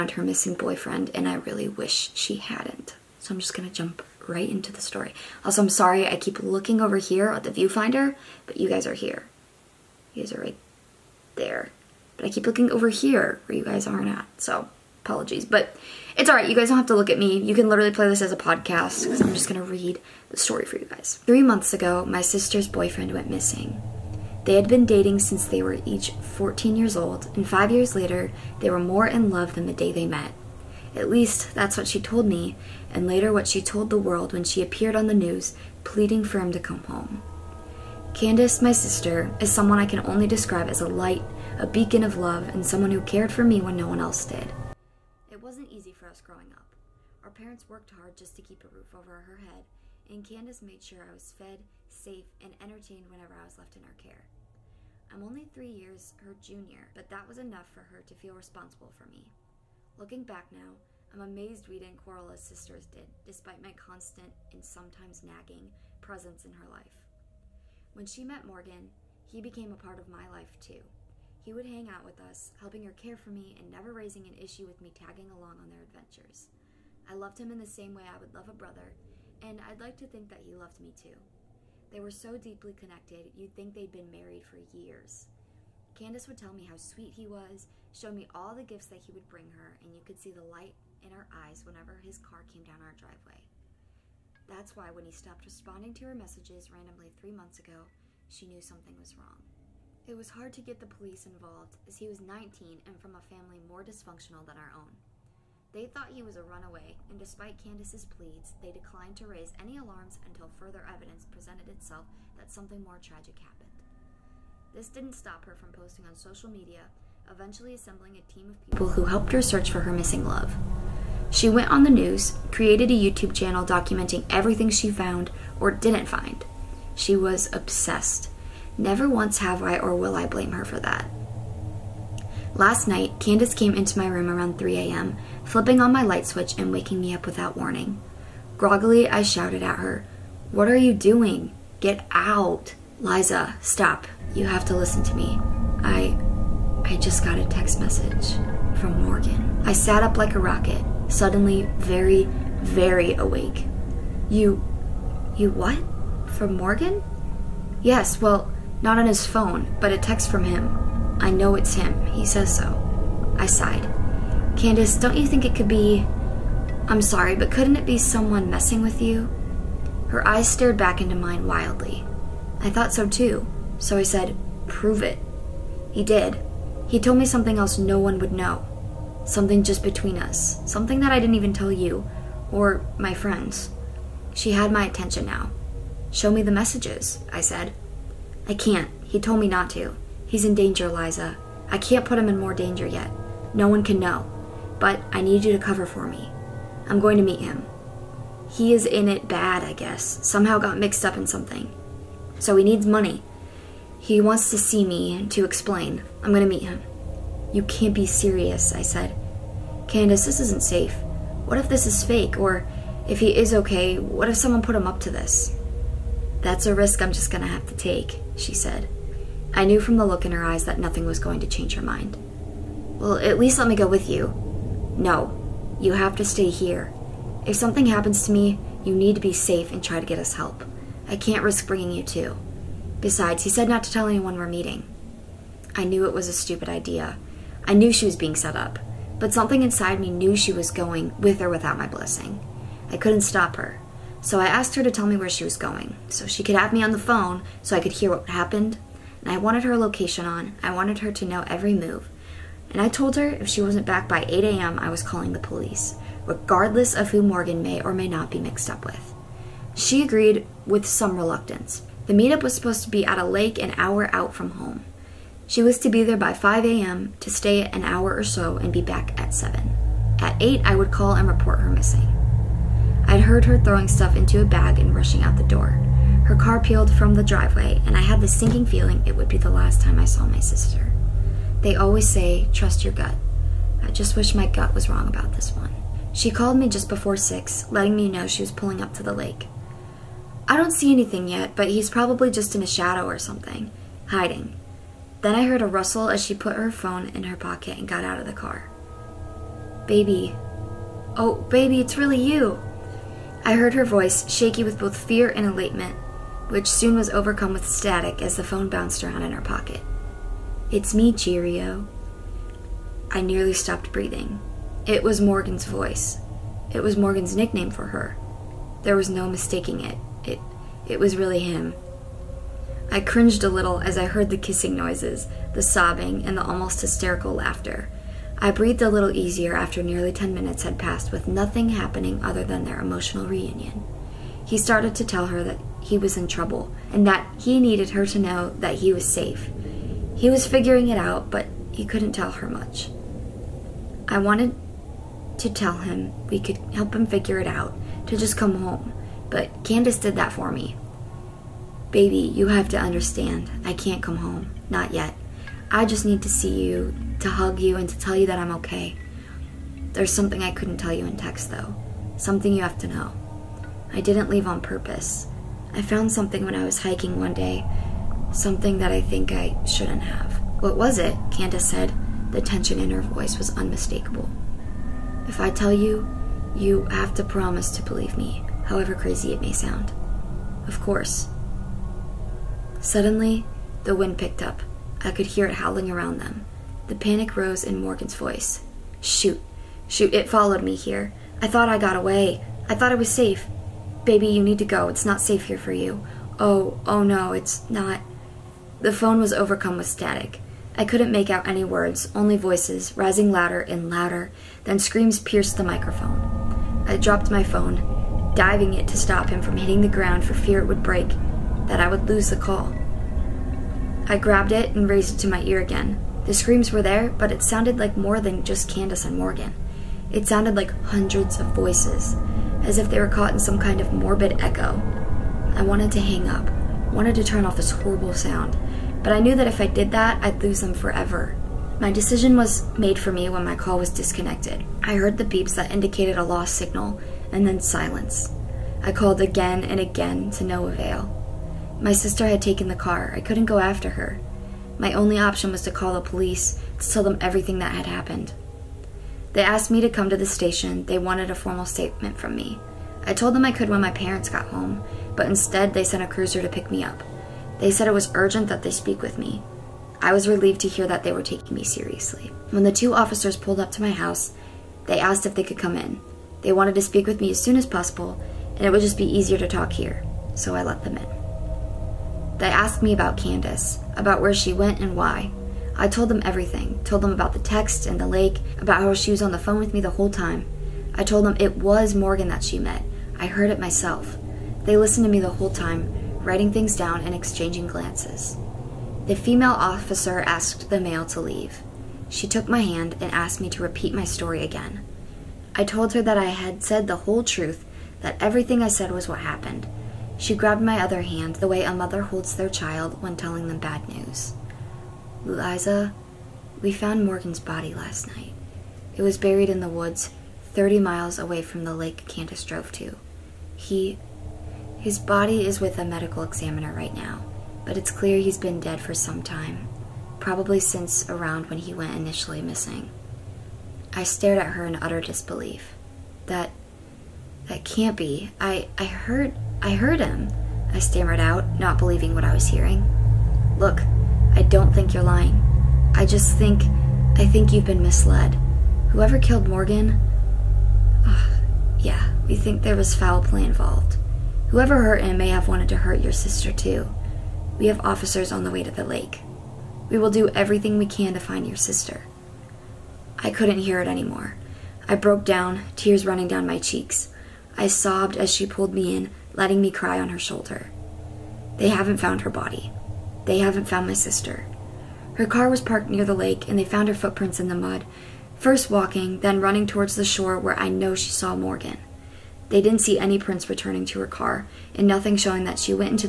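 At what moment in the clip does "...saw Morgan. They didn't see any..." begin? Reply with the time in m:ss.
9:31.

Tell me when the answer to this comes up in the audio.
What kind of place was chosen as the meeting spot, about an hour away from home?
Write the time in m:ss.
4:23.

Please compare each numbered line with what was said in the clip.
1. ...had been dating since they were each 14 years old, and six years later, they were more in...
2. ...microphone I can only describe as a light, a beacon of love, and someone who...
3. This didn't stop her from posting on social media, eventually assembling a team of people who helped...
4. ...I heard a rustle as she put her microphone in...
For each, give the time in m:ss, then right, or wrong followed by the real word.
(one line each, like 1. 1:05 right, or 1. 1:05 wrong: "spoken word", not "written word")
1. 0:24 wrong: "five", not "six"
2. 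0:39 wrong: "someone", not "microphone"
3. 1:54 right
4. 4:55 wrong: "phone", not "microphone".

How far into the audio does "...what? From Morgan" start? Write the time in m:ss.
2:35.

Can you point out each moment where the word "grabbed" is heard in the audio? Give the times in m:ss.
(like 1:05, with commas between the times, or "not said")
6:54, 8:20.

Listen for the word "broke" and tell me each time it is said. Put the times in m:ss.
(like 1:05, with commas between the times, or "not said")
9:14.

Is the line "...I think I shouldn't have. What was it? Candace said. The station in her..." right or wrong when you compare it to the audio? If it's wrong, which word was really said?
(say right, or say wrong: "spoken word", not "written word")
wrong: "tension", not "station".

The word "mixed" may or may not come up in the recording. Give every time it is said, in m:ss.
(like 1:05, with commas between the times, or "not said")
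3:20, 4:18.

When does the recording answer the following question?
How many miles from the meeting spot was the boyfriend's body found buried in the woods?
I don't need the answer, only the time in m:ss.
8:30.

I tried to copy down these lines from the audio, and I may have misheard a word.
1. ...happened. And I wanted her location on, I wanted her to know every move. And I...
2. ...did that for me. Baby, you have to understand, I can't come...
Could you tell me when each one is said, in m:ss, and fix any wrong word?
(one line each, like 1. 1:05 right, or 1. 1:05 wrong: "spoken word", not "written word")
1. 4:08 right
2. 5:49 right.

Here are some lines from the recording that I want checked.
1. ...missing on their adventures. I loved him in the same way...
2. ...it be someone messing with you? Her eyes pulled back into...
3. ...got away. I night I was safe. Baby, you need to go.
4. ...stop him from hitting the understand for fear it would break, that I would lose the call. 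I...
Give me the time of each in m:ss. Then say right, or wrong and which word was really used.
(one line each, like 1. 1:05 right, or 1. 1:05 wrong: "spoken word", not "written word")
1. 1:15 wrong: "along", not "missing"
2. 2:47 wrong: "stared", not "pulled"
3. 6:31 wrong: "thought", not "night"
4. 6:48 wrong: "ground", not "understand".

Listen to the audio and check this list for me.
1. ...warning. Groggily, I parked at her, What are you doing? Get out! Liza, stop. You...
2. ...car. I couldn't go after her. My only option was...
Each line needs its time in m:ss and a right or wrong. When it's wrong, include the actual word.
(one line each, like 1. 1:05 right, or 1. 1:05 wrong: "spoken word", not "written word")
1. 2:17 wrong: "shouted", not "parked"
2. 7:22 right.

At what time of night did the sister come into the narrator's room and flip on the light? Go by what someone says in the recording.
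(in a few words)
3 a.m.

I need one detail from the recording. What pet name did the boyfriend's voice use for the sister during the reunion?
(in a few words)
Cheerio.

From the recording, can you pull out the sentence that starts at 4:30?
At 8, I would call and report her missing heard her throwing stuff into a bag and rushing out the door.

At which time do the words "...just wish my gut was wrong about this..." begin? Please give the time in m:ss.
4:43.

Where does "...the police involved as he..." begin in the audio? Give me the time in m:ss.
1:40.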